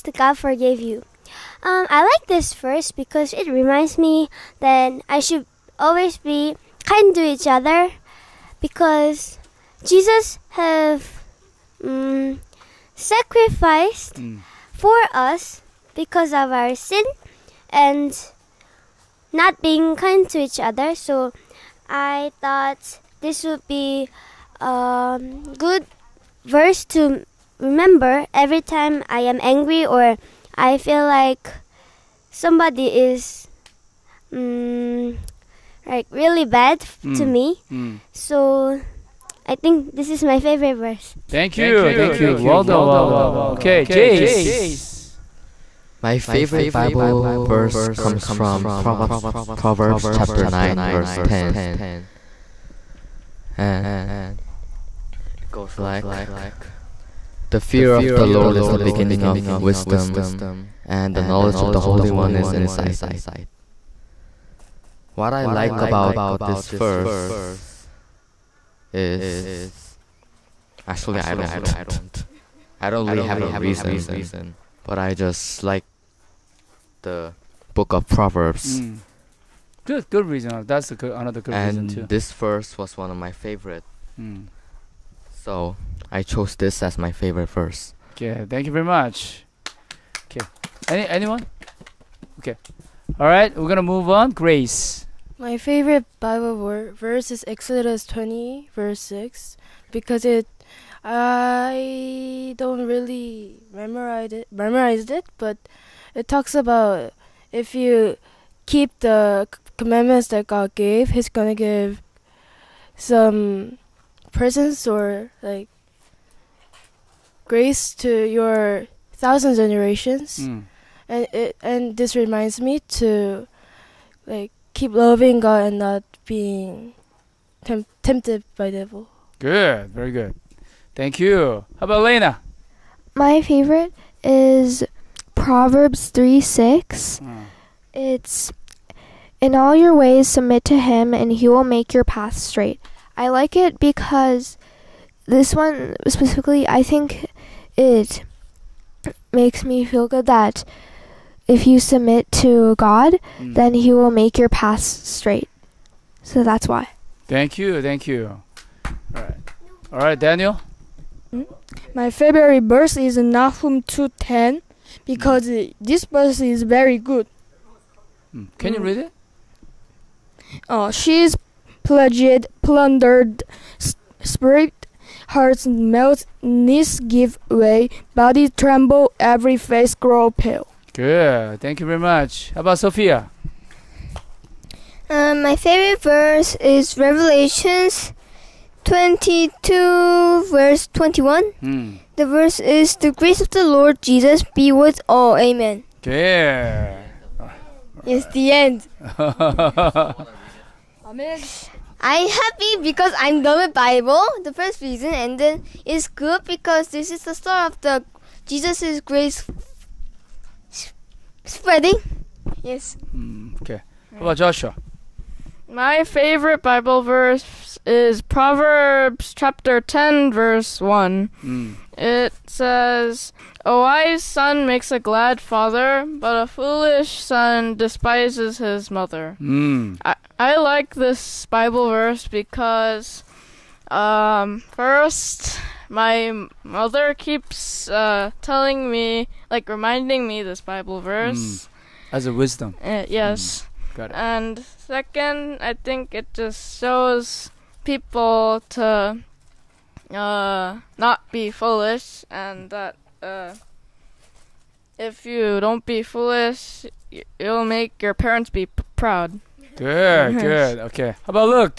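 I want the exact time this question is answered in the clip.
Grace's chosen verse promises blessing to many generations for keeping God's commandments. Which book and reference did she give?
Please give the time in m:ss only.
1:37.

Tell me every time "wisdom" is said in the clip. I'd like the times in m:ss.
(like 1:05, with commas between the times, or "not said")
0:59, 4:02.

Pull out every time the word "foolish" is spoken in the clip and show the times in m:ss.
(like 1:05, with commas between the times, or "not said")
3:46, 4:11, 4:16.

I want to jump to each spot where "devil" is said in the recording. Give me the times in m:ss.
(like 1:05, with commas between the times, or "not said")
2:08.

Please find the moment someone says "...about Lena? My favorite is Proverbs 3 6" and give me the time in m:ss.
2:11.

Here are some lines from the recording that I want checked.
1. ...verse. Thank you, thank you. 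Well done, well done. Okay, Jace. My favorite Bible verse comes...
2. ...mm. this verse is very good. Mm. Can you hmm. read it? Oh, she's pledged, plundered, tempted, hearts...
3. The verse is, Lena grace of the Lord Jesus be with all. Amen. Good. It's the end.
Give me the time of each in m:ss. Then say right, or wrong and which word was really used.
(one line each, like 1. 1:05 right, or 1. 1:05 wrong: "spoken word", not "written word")
1. 0:40 right
2. 2:45 wrong: "stripped", not "tempted"
3. 3:12 wrong: "The", not "Lena".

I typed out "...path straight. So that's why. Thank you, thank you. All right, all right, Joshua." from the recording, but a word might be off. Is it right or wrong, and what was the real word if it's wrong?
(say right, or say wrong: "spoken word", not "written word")
wrong: "Daniel", not "Joshua".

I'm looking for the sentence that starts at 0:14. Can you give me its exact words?
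for us because of our sin and not being kind to each other.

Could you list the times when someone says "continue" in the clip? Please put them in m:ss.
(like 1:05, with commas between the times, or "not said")
not said.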